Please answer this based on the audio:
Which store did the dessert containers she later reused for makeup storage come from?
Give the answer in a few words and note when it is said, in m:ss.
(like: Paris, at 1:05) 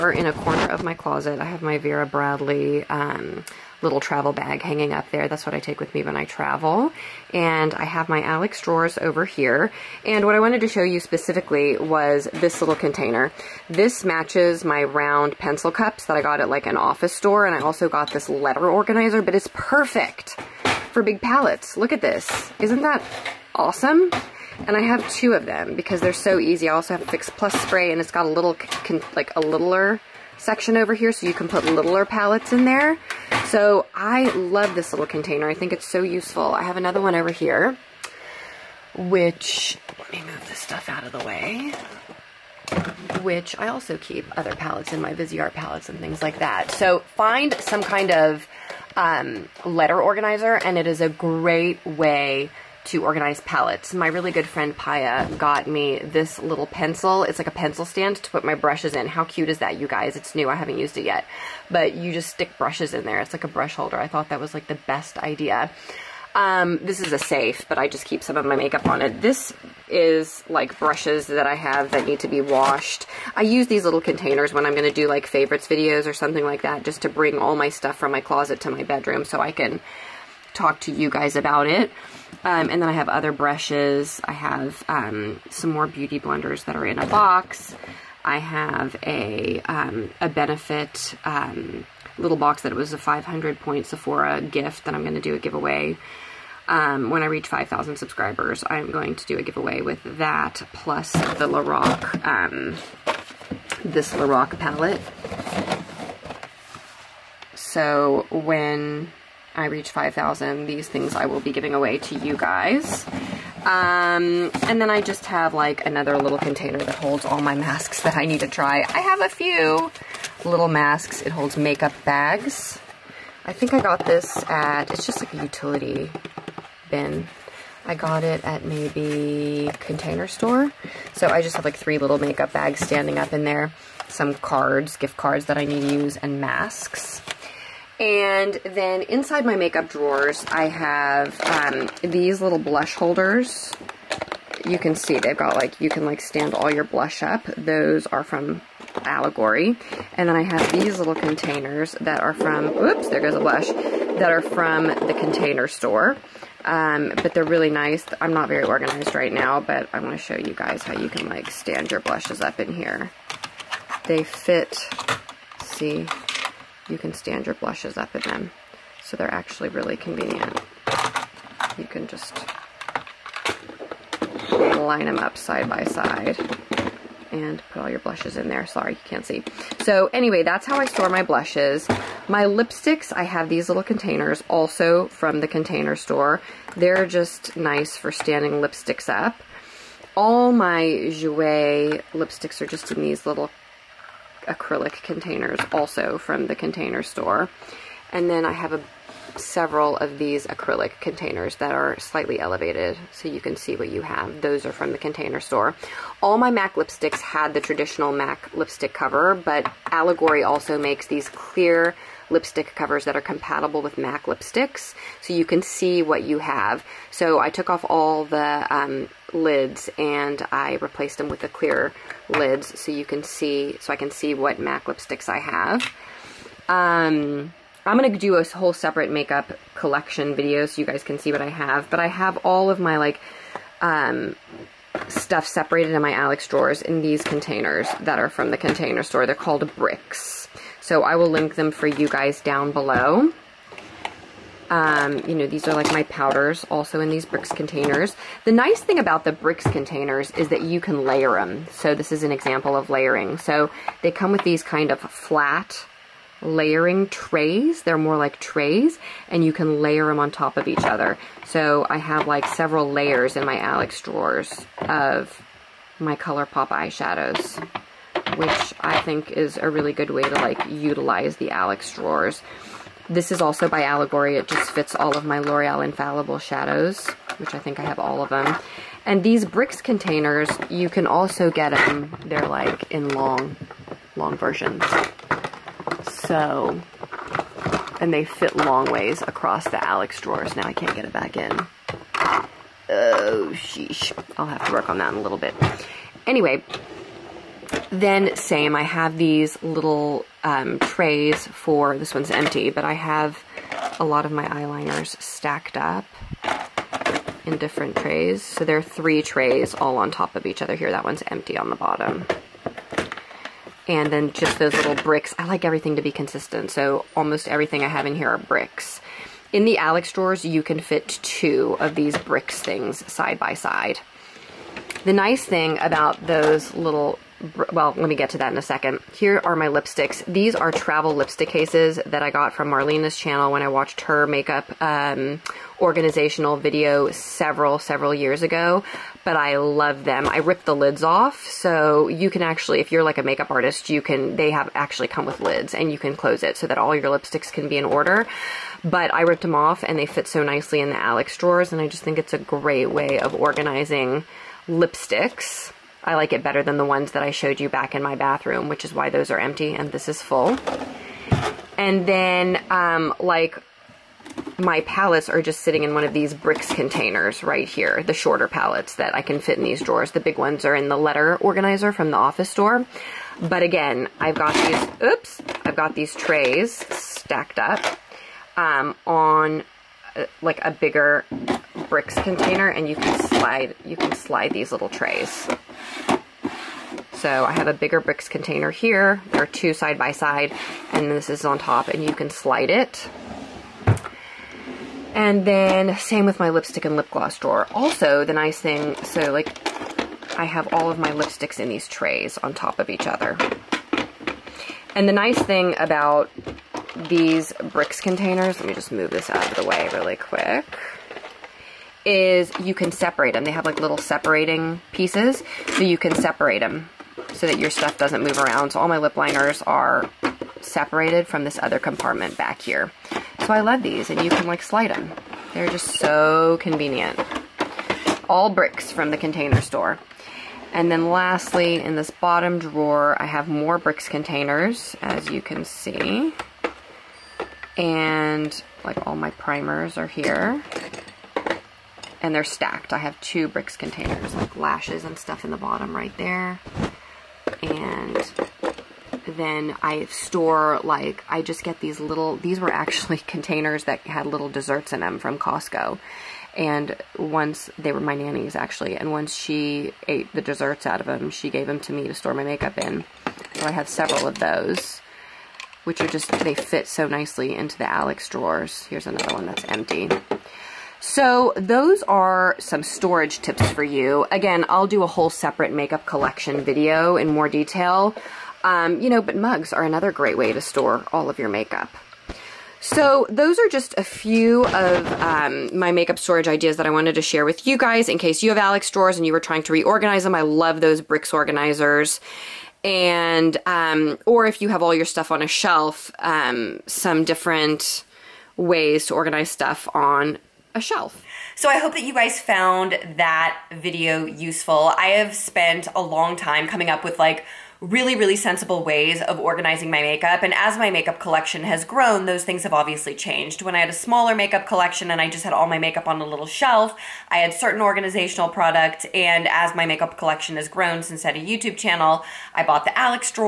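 Costco, at 7:35.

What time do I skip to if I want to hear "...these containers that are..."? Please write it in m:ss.
3:57.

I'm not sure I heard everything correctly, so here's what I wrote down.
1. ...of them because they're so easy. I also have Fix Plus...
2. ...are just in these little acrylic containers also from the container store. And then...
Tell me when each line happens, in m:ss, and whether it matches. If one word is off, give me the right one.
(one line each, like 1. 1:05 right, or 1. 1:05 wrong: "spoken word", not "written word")
1. 0:25 right
2. 3:12 right.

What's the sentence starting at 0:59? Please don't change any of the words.
How cute is that, you guys?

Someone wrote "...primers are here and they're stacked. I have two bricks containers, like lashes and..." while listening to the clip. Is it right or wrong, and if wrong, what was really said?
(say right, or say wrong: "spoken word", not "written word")
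right.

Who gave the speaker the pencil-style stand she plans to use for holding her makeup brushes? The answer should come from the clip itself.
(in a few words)
Paya.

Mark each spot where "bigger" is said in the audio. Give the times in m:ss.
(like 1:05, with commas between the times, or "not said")
6:20, 6:27.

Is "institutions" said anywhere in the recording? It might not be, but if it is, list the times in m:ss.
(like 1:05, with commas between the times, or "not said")
not said.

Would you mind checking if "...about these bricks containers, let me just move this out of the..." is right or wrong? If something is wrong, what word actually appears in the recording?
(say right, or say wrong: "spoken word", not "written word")
right.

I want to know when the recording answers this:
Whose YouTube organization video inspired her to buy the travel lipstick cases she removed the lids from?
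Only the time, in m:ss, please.
5:32.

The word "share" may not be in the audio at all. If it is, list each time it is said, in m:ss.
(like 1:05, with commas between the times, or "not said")
8:07.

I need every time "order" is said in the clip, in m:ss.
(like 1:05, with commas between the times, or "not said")
5:47.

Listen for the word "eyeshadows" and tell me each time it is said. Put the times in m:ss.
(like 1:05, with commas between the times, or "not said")
4:26.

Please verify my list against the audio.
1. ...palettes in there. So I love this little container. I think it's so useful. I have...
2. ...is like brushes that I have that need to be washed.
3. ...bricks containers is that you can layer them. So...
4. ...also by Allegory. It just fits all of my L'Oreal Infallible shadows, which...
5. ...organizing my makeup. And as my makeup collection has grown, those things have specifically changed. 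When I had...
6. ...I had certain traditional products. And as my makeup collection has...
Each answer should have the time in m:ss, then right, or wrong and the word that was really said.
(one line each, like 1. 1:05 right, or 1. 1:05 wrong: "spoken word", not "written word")
1. 0:32 right
2. 1:09 right
3. 4:09 right
4. 4:33 right
5. 8:29 wrong: "obviously", not "specifically"
6. 8:37 wrong: "organizational", not "traditional".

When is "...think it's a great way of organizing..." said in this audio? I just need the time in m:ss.
5:52.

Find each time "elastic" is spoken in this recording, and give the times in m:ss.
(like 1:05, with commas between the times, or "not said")
not said.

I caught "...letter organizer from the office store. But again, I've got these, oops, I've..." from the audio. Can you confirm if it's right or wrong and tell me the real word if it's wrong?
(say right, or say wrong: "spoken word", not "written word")
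right.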